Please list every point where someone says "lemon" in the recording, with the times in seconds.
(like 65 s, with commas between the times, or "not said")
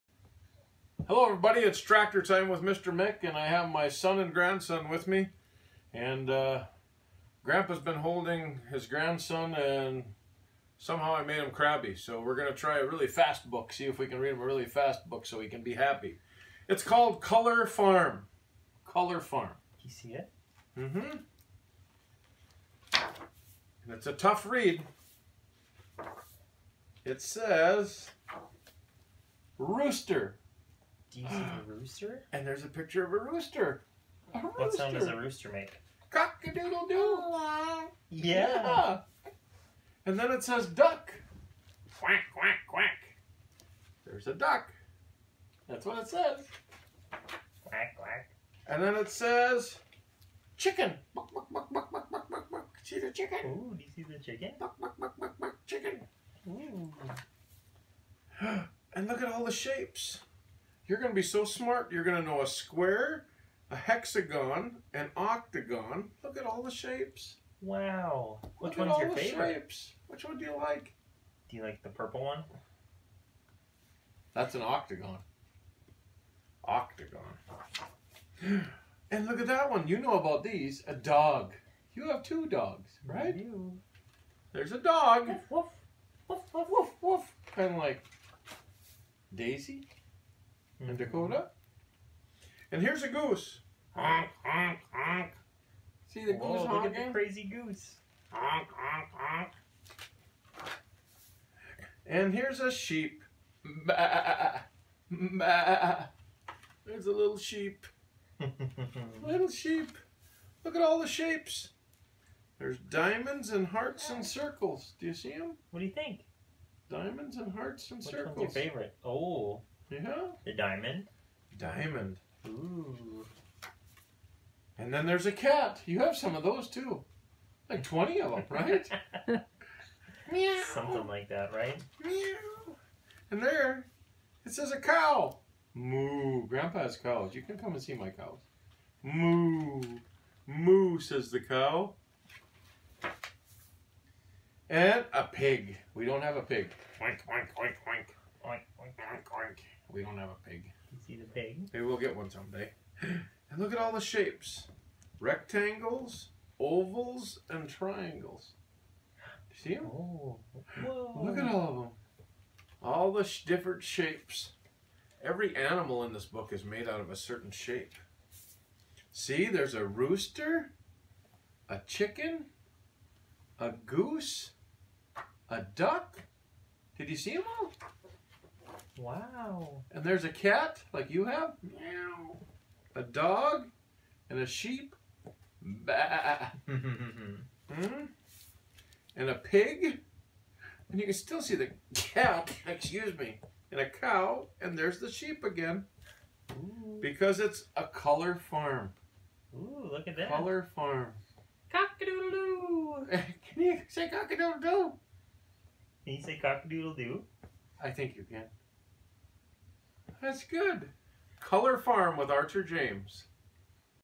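not said.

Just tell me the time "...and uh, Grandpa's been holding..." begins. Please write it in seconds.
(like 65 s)
5 s.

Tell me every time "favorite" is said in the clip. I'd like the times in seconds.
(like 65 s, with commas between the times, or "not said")
69 s, 118 s.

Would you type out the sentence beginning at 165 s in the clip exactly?
Every animal in this book is made out of a certain shape.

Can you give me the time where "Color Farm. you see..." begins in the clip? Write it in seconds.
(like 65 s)
18 s.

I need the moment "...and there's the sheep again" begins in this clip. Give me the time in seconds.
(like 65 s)
194 s.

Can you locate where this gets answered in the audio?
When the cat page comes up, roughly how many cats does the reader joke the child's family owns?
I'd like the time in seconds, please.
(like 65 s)
127 s.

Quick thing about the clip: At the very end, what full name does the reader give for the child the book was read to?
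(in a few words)
Archer James.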